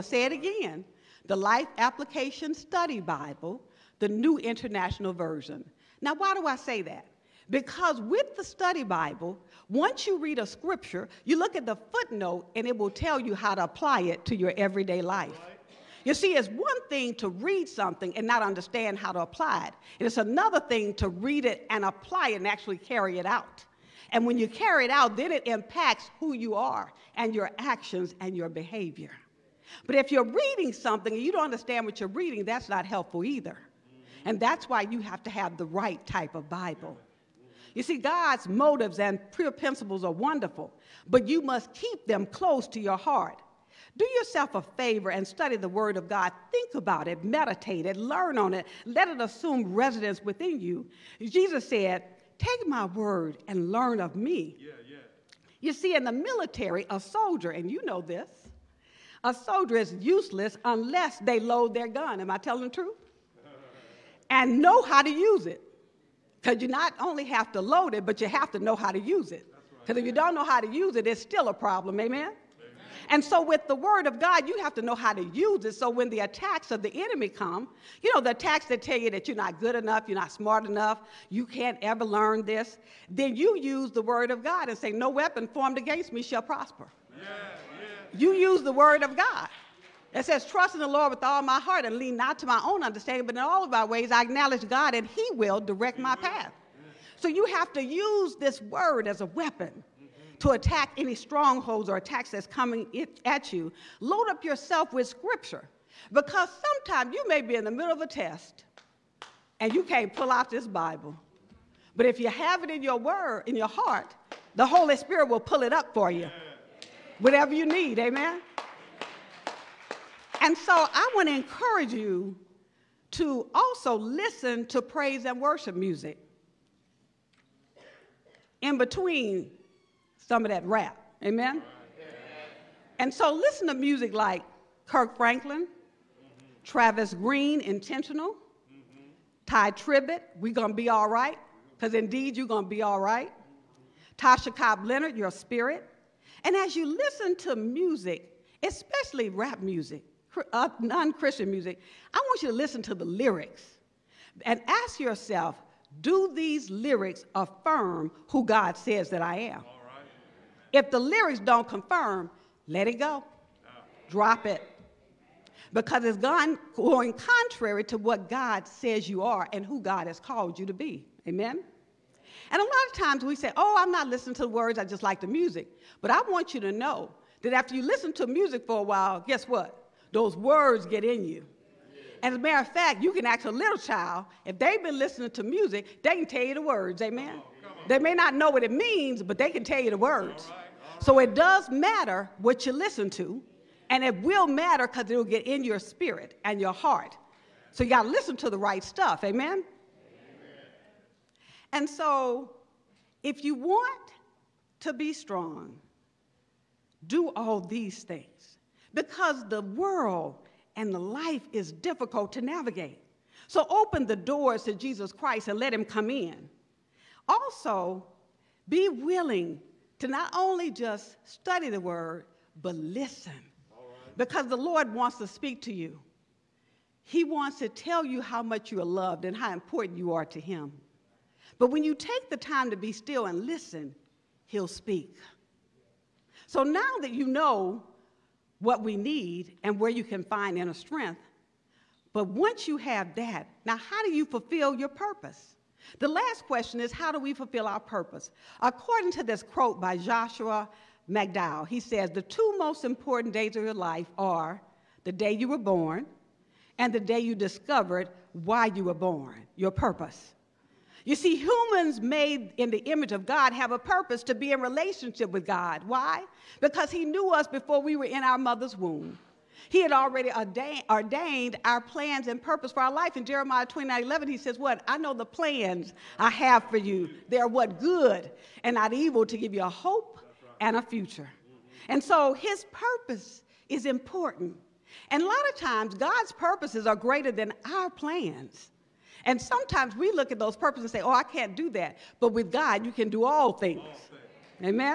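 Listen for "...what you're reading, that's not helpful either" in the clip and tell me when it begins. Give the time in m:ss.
0:31.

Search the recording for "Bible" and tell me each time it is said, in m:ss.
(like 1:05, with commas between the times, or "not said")
0:02, 0:08, 0:36, 1:50.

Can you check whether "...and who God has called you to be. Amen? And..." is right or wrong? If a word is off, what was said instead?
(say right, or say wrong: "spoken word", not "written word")
right.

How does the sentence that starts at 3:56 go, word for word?
So now that you know what we need and where you can find inner strength.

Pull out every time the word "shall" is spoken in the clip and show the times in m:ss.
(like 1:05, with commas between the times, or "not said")
1:26.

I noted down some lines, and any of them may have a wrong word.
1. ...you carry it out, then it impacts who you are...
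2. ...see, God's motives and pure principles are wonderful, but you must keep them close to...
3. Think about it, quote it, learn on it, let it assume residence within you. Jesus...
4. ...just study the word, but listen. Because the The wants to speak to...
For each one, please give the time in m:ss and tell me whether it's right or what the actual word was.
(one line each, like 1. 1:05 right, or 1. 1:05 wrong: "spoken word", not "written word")
1. 0:24 right
2. 0:37 right
3. 0:46 wrong: "meditate", not "quote"
4. 3:40 wrong: "Lord", not "The".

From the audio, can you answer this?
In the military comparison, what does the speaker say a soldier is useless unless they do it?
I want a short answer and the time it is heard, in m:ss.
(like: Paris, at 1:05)
load their gun, at 1:01.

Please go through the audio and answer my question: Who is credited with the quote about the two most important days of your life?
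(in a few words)
Joshua McDowell.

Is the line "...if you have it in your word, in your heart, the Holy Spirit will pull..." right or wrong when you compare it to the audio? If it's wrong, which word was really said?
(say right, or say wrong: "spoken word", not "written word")
right.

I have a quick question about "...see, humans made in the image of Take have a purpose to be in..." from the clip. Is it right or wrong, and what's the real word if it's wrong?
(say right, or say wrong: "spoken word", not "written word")
wrong: "God", not "Take".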